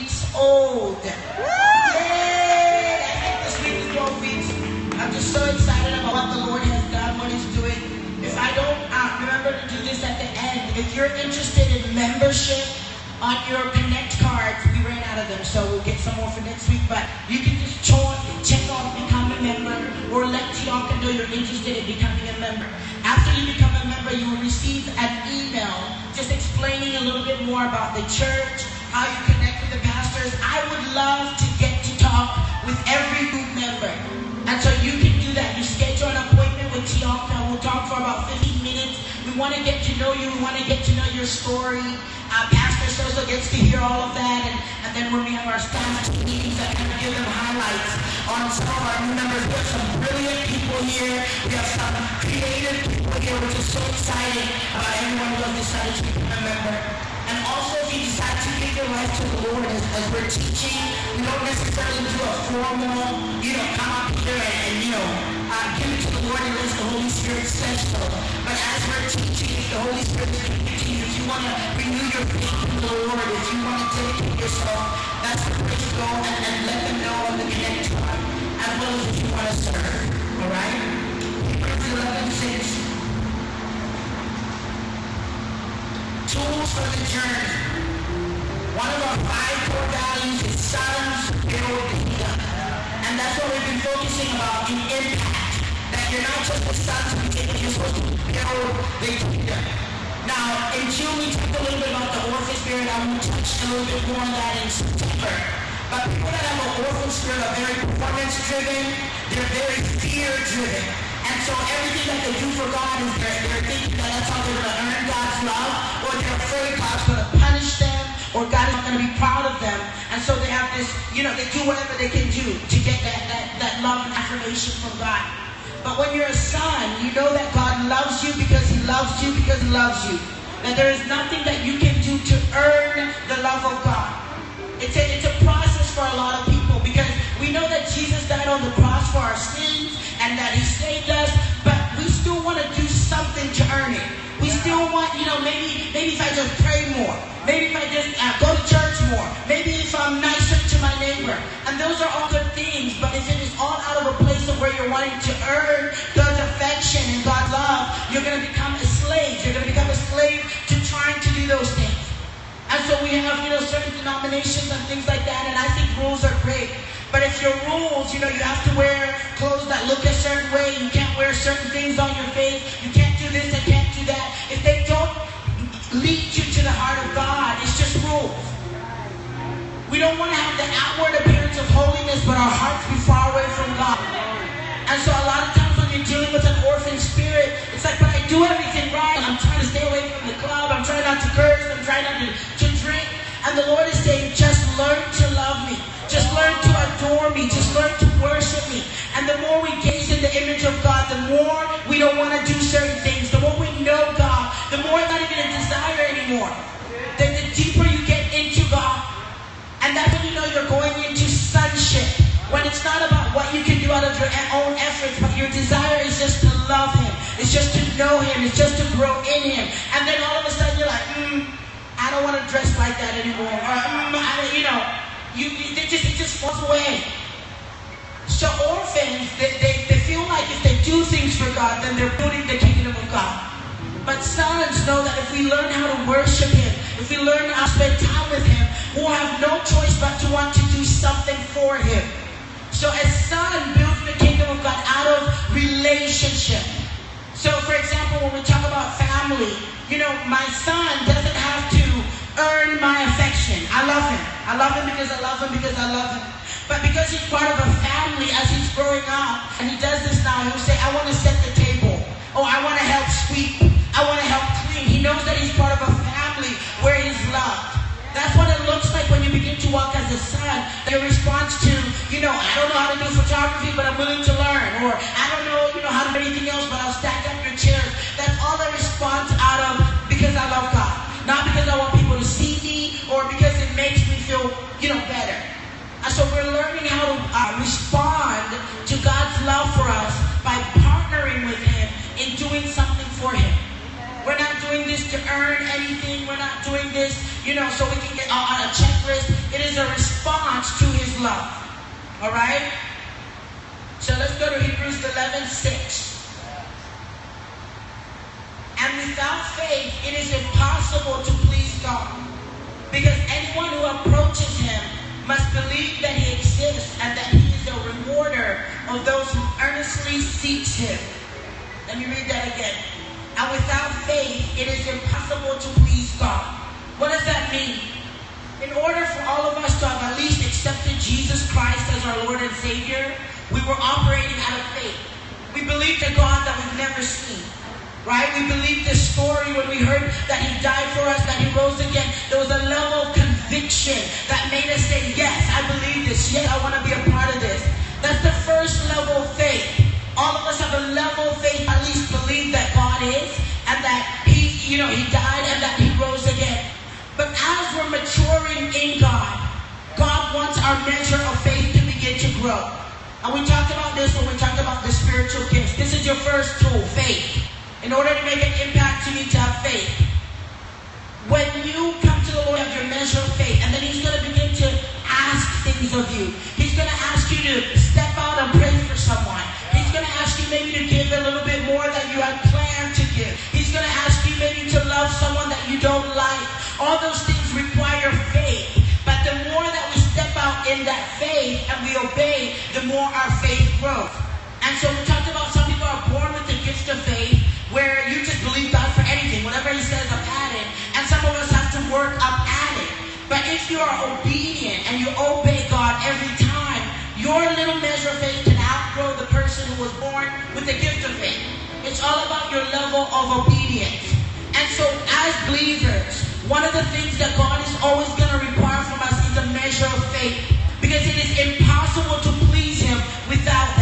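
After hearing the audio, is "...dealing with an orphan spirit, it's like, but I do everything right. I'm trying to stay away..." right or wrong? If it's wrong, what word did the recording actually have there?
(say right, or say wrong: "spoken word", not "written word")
right.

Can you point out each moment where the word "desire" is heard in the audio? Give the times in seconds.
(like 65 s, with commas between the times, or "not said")
205 s, 215 s.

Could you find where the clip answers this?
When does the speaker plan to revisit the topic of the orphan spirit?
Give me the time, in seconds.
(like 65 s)
104 s.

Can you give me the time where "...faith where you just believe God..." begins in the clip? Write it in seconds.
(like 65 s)
397 s.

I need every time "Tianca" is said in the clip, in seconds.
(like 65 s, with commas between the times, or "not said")
20 s, 36 s.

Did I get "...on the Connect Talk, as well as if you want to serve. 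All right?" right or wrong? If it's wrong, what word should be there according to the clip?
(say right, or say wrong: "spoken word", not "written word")
right.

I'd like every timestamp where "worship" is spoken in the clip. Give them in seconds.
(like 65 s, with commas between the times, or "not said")
198 s, 236 s.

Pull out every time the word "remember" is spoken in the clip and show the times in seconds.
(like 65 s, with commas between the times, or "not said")
9 s.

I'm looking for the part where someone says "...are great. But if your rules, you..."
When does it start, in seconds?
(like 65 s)
166 s.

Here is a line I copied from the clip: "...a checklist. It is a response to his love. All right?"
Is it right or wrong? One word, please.
right.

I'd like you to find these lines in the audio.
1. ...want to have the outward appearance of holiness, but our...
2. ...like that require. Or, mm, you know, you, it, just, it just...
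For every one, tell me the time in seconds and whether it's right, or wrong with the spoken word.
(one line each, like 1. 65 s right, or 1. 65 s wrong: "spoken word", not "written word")
1. 180 s right
2. 222 s wrong: "anymore", not "require".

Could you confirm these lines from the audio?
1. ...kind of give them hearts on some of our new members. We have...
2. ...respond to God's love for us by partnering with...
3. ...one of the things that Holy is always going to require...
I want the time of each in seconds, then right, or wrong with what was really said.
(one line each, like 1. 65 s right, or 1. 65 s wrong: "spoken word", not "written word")
1. 46 s wrong: "highlights", not "hearts"
2. 287 s right
3. 416 s wrong: "God", not "Holy".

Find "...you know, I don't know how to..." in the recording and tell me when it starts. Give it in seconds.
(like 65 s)
272 s.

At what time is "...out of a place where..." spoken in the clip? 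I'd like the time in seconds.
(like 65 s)
153 s.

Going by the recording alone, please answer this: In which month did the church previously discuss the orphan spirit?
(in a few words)
June.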